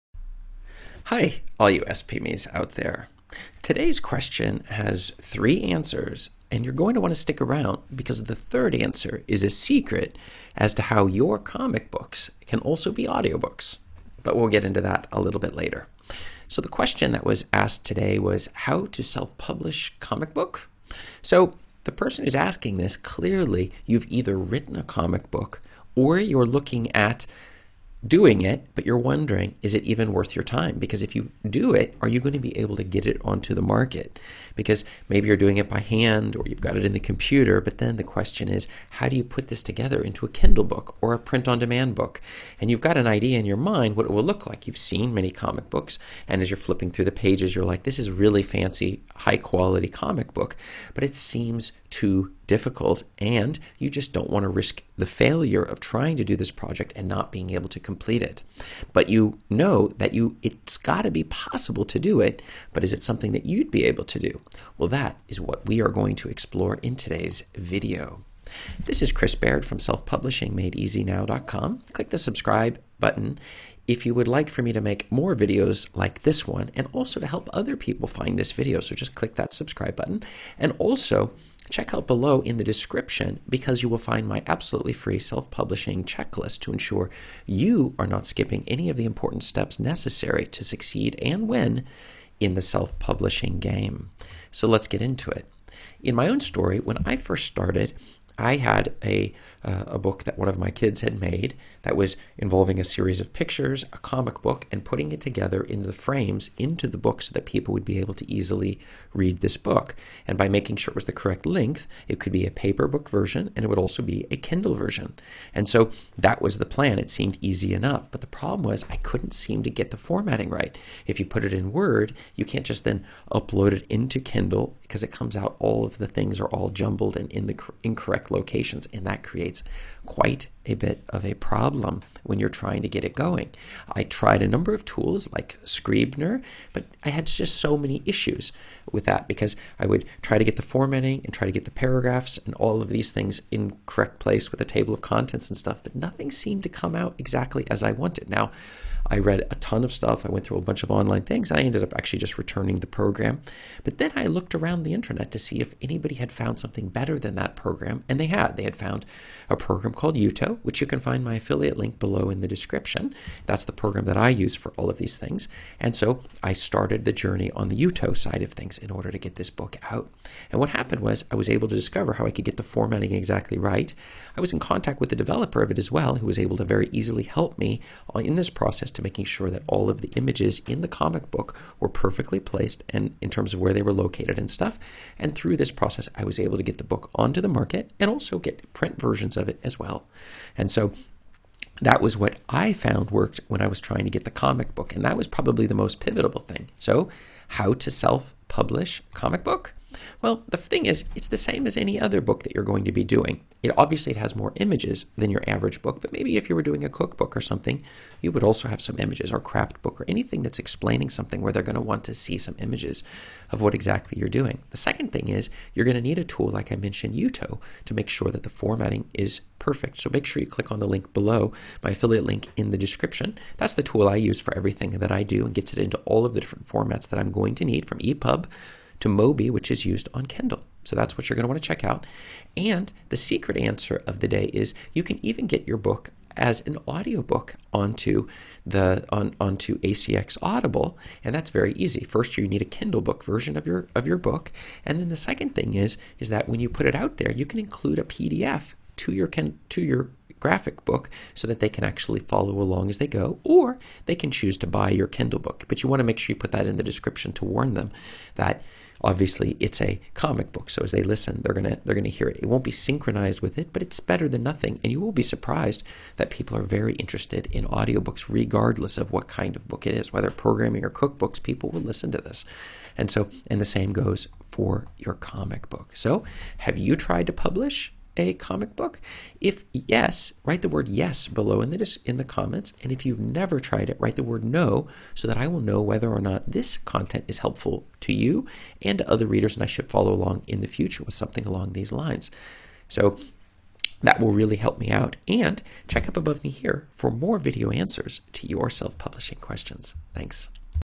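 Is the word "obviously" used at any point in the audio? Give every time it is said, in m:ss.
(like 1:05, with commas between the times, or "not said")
3:23, 4:19.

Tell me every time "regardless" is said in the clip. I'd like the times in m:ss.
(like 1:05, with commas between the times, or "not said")
4:28.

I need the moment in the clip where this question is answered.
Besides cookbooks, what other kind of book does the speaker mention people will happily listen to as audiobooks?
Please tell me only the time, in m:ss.
4:30.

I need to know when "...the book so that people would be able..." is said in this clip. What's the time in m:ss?
1:46.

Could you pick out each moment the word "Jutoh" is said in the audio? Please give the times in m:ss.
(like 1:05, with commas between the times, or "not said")
2:40, 2:47, 3:37.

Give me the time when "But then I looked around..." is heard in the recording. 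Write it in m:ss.
2:33.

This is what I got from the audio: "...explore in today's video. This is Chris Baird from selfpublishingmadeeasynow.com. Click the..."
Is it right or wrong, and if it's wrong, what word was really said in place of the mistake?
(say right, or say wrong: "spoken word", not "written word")
right.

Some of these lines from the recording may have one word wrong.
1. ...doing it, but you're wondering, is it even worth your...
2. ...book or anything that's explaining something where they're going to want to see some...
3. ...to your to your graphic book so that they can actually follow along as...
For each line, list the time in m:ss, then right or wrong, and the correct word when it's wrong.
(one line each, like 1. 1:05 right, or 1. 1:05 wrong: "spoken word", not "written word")
1. 0:28 right
2. 3:29 right
3. 4:08 right.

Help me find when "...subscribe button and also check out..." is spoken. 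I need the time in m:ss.
1:19.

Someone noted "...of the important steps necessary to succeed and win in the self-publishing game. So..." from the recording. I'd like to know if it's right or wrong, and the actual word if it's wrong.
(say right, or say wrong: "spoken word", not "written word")
right.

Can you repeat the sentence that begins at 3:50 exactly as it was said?
So that's what you're going to want to check out.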